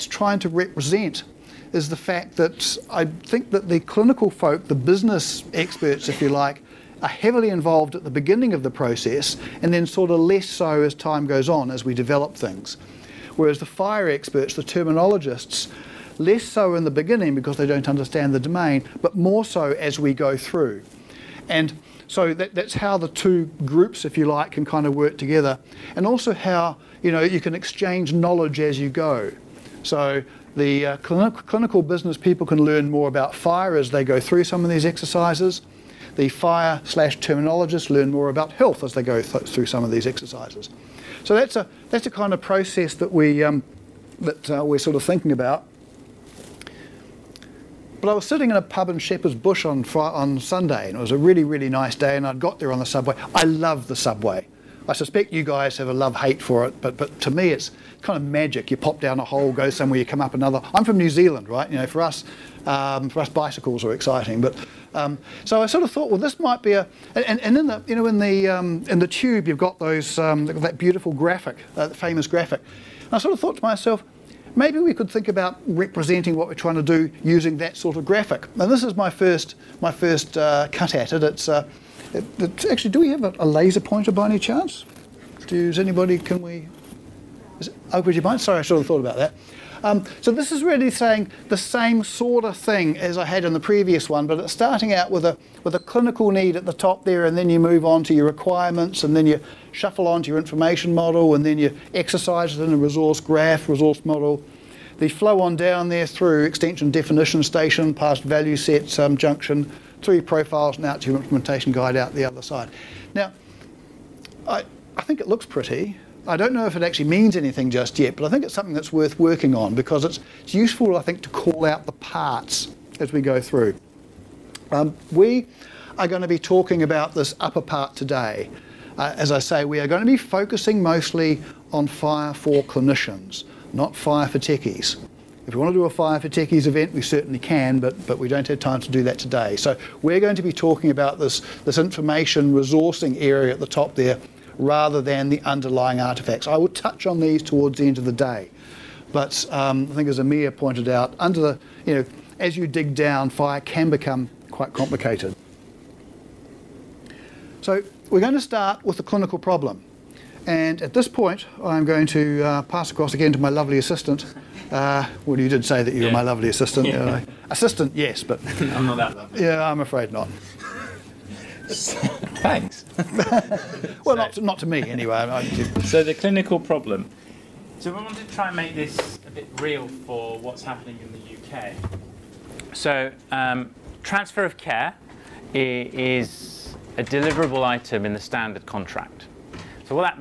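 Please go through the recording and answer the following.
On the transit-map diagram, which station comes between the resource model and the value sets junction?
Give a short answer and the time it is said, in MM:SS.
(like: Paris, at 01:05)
extension definition station, at 01:46.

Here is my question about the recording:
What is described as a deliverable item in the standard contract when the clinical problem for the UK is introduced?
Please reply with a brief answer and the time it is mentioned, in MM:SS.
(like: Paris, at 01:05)
transfer of care, at 03:04.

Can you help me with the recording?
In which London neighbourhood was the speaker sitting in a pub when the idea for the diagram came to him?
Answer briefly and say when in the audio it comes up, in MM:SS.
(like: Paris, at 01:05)
Shepherd's Bush, at 00:48.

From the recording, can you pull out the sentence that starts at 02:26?
I will touch on these towards the end of the day.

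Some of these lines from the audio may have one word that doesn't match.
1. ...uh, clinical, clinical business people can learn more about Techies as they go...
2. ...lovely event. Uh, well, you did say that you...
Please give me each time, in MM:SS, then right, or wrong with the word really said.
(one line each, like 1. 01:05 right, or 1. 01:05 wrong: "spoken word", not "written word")
1. 00:30 wrong: "FHIR", not "Techies"
2. 02:43 wrong: "assistant", not "event".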